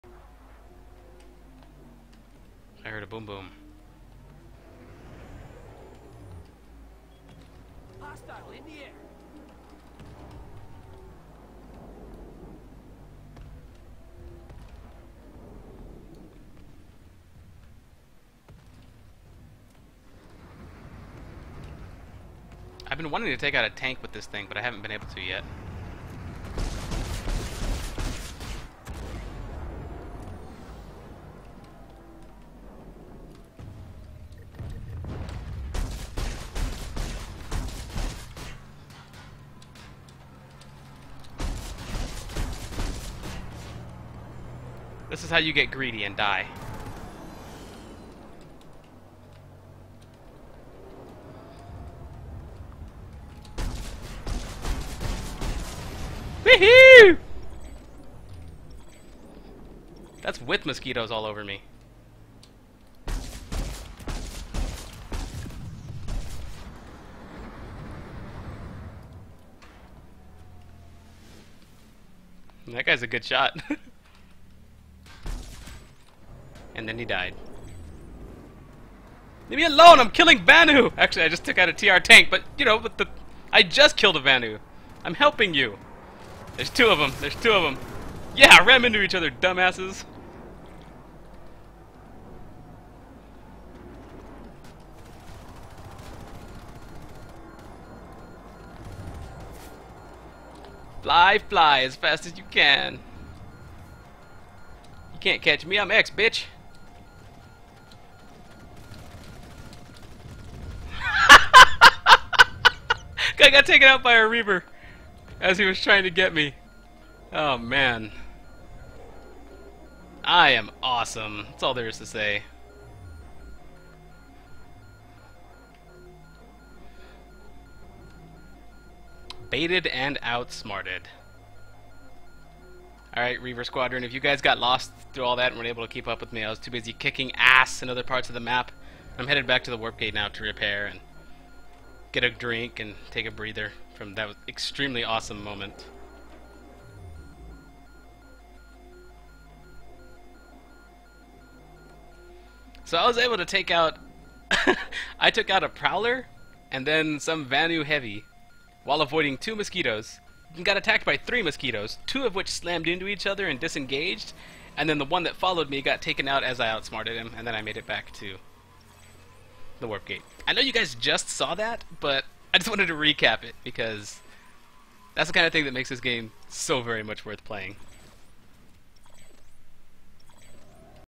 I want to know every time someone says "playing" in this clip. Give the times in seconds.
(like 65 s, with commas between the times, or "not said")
177 s.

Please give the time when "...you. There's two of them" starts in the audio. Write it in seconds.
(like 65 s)
85 s.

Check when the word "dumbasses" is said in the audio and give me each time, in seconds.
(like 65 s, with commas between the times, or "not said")
89 s.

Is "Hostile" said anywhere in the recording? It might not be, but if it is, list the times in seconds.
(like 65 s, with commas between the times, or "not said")
8 s.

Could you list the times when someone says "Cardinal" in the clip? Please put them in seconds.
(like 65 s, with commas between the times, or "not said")
not said.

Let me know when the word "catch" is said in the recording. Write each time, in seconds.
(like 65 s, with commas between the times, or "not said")
105 s.